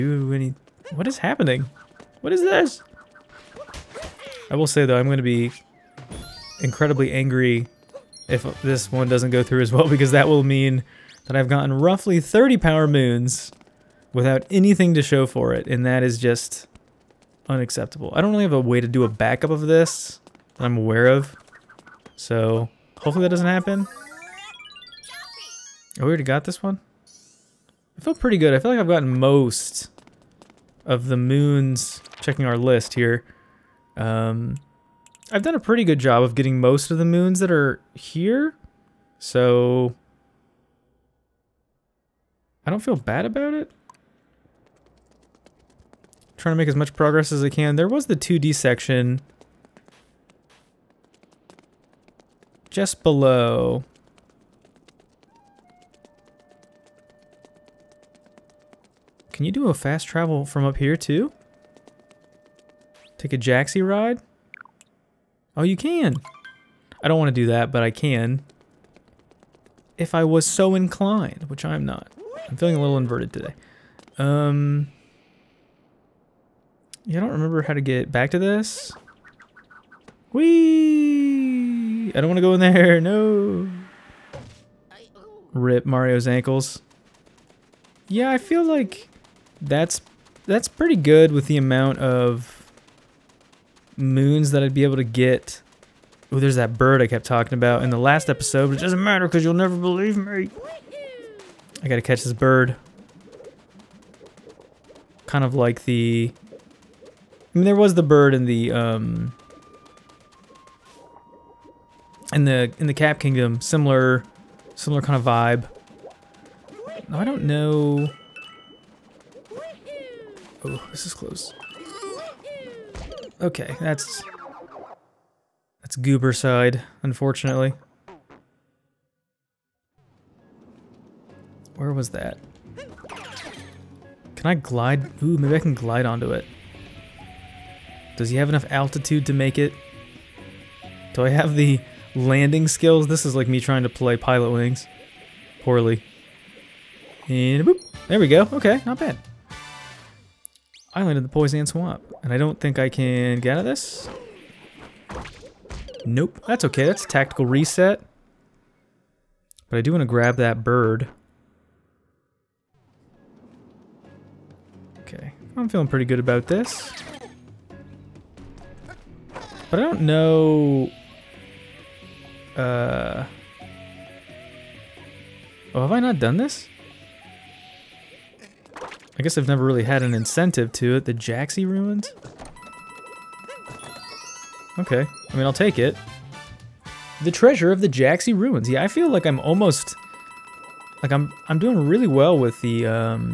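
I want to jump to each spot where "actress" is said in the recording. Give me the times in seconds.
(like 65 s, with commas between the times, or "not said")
not said.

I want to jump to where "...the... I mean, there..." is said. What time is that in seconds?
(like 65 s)
105 s.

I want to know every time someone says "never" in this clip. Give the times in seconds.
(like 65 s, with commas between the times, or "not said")
99 s, 179 s.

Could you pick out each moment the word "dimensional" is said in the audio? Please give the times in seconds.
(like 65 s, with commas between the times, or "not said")
not said.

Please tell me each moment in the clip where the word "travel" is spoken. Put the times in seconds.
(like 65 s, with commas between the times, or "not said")
60 s.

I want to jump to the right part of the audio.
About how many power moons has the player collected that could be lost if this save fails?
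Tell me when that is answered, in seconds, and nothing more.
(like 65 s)
12 s.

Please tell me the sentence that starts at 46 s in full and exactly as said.
trying to make as much progress as I can.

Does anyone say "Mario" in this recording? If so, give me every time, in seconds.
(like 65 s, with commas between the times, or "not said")
85 s.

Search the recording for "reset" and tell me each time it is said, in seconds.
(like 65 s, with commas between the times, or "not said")
157 s.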